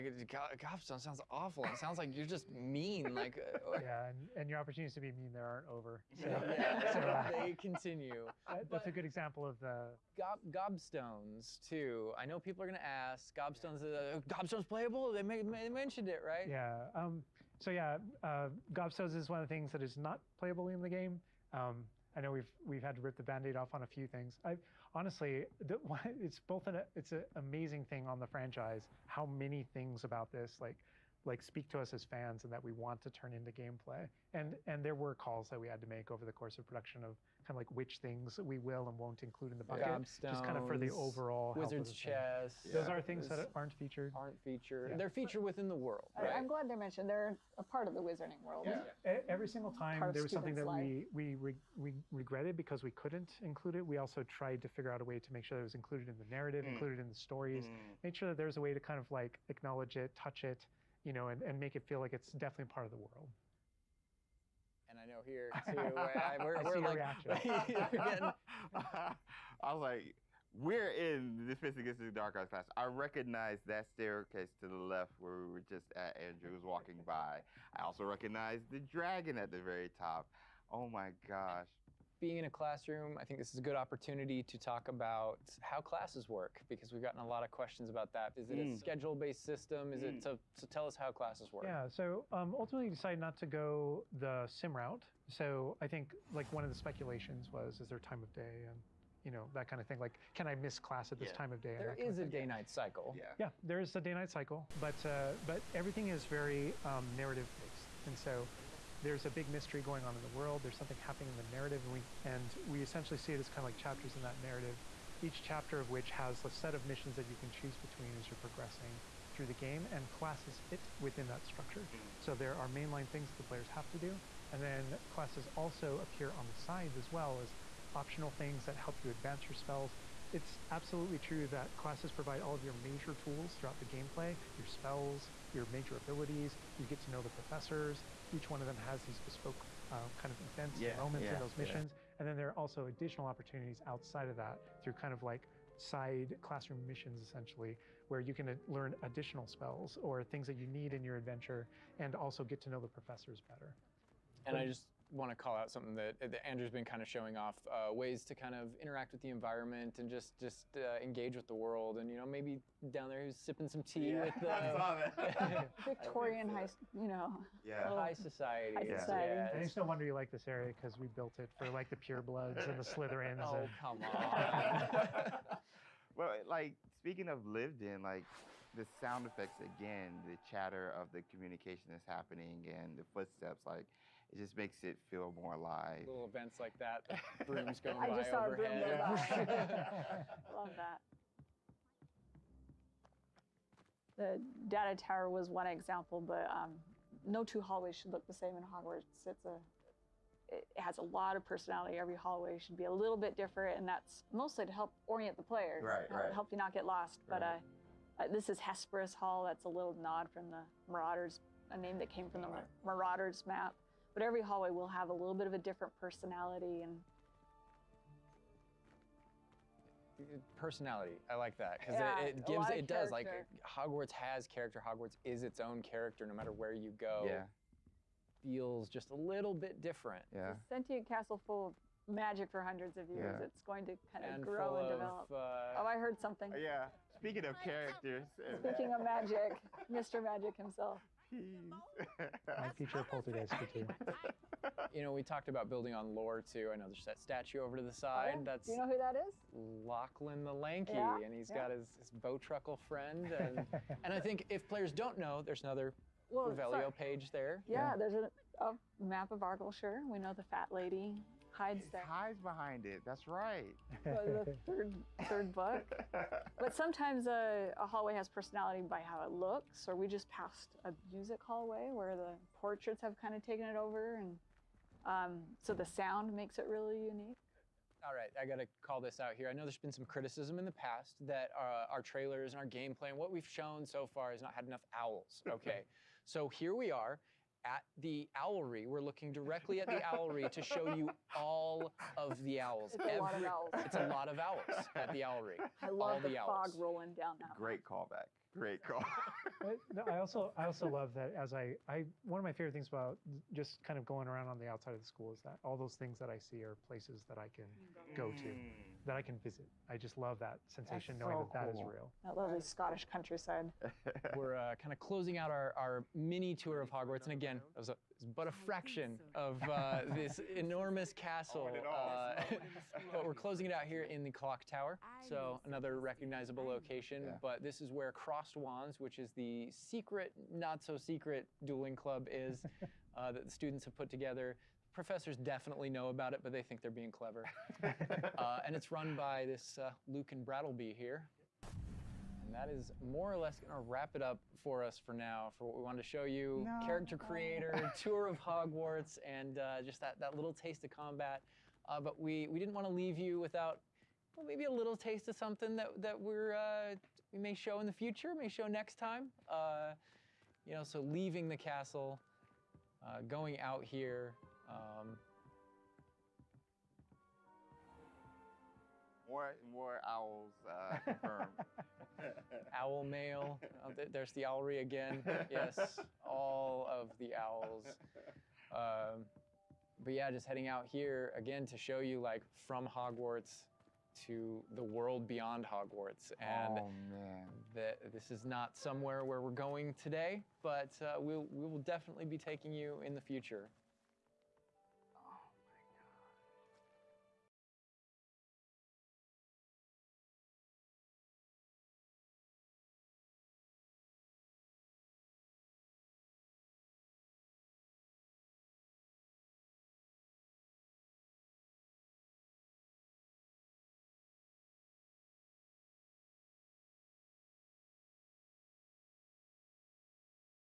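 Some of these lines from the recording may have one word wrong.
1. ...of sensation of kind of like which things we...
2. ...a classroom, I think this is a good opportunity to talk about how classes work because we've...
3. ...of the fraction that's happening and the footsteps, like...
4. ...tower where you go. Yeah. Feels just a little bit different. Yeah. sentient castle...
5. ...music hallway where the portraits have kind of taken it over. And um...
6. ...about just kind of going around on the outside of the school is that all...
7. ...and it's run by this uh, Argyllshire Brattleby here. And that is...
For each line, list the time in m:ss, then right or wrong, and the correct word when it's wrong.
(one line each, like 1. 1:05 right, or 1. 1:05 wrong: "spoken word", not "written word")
1. 0:36 wrong: "production", not "sensation"
2. 1:22 right
3. 3:00 wrong: "communication", not "fraction"
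4. 3:46 wrong: "matter", not "tower"
5. 4:31 right
6. 5:02 right
7. 5:38 wrong: "Lucan", not "Argyllshire".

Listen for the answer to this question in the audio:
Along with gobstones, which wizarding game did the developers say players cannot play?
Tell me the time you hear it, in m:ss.
0:41.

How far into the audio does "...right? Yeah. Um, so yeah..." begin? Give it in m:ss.
0:16.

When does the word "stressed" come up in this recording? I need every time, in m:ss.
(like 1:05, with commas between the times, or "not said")
not said.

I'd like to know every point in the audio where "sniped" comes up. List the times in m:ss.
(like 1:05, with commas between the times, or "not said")
not said.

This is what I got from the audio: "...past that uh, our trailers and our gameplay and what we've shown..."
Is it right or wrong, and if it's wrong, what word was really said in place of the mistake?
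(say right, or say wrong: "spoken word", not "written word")
right.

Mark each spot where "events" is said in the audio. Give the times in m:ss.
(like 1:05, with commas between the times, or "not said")
2:20, 3:06.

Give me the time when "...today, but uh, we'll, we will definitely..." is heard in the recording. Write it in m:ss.
6:30.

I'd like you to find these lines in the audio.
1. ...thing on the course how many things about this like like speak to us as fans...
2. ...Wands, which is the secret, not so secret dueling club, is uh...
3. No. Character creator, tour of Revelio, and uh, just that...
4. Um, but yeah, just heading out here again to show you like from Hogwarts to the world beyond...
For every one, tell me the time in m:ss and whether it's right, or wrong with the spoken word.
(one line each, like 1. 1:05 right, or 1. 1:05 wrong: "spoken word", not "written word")
1. 0:27 wrong: "franchise", not "course"
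2. 5:28 right
3. 5:46 wrong: "Hogwarts", not "Revelio"
4. 6:18 right.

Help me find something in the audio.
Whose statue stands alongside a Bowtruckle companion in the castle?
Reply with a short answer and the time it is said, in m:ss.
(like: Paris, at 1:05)
Lachlan the Lanky, at 4:09.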